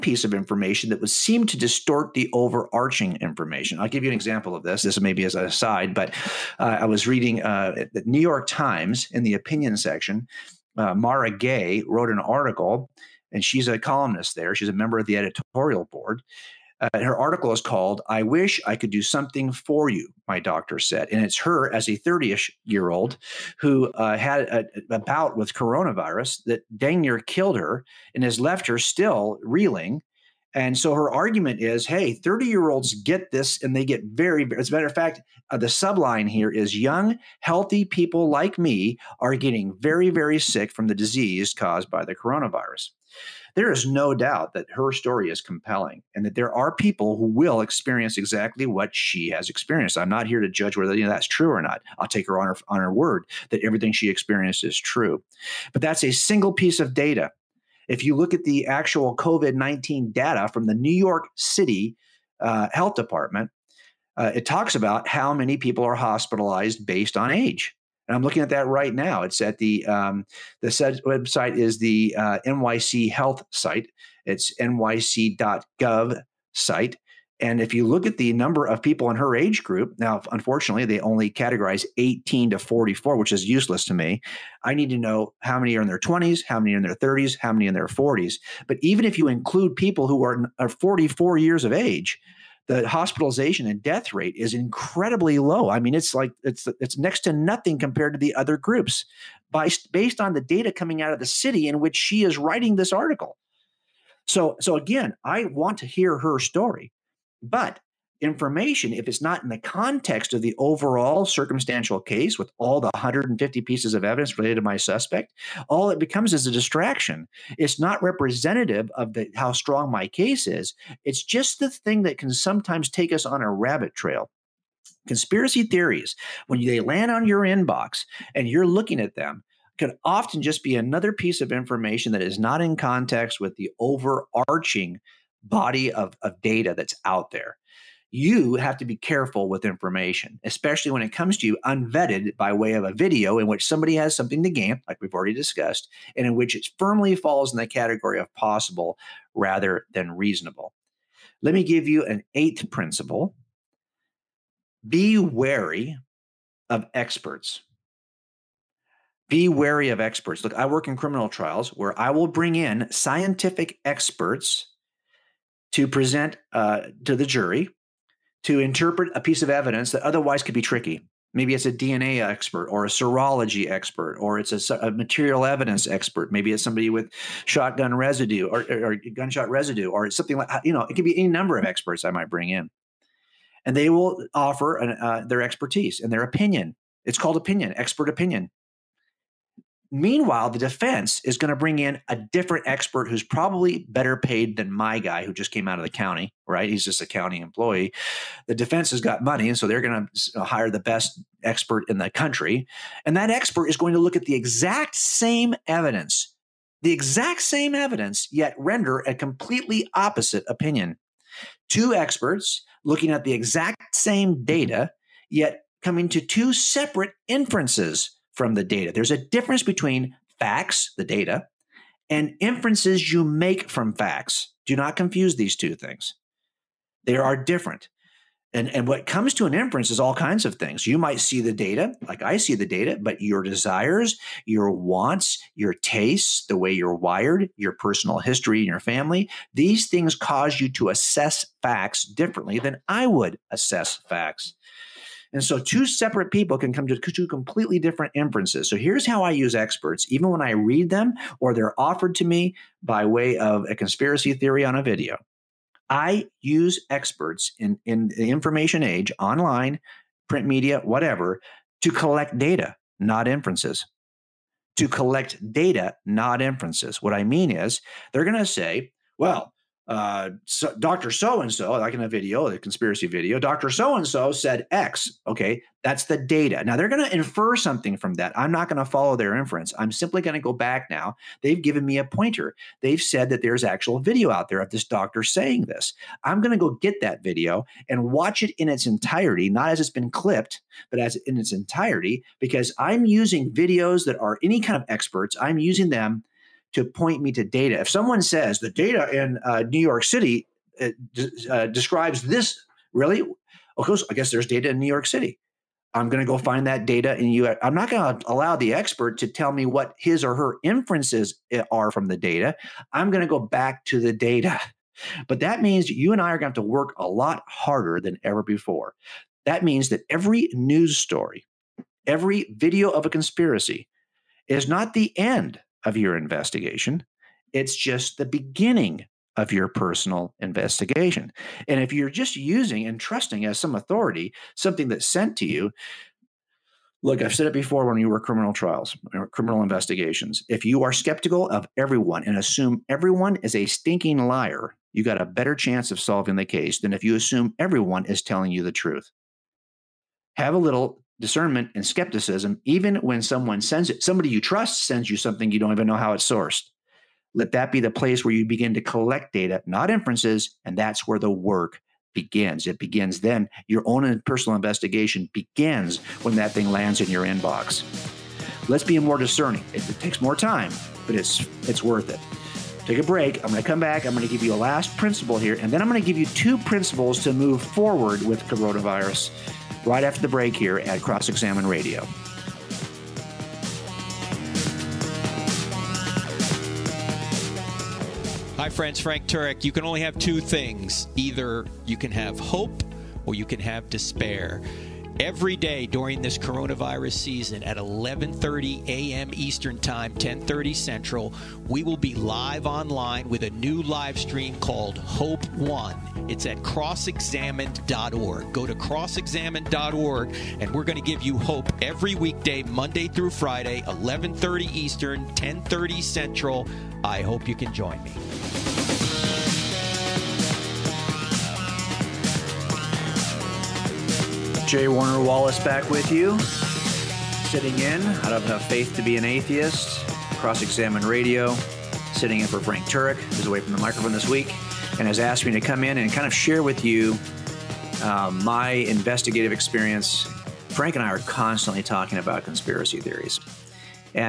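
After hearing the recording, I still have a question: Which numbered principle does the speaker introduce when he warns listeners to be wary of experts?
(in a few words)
eighth.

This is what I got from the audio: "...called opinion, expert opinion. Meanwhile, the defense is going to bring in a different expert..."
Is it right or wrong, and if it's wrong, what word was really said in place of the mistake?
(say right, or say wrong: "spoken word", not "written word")
right.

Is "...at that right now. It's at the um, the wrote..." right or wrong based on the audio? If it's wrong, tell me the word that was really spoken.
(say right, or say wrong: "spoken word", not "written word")
wrong: "website", not "wrote".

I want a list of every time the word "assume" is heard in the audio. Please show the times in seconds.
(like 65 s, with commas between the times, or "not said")
342 s, 347 s.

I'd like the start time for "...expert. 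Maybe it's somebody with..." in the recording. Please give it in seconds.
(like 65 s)
175 s.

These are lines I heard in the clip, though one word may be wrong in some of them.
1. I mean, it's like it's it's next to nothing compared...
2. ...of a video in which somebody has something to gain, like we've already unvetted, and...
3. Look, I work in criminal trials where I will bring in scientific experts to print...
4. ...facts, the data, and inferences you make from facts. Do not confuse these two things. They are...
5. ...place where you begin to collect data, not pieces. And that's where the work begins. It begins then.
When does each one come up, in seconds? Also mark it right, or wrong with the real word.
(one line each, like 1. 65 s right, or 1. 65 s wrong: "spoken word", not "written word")
1. 95 s right
2. 142 s wrong: "discussed", not "unvetted"
3. 160 s wrong: "present", not "print"
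4. 220 s right
5. 357 s wrong: "inferences", not "pieces".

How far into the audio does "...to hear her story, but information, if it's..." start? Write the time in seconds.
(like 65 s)
105 s.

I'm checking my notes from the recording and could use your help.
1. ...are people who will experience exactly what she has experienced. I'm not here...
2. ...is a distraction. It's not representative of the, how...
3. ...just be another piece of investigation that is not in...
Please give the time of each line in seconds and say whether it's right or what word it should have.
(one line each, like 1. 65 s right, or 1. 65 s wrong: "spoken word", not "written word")
1. 46 s right
2. 116 s right
3. 130 s wrong: "information", not "investigation".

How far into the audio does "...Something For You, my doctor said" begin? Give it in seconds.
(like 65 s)
19 s.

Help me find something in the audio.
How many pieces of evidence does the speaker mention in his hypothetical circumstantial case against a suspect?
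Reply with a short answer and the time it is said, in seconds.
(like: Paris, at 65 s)
150, at 112 s.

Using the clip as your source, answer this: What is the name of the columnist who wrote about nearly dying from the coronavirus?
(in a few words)
Mara Gay.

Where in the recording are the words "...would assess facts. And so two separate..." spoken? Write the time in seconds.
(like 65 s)
243 s.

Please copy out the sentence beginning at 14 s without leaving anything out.
She's a member of the editorial board.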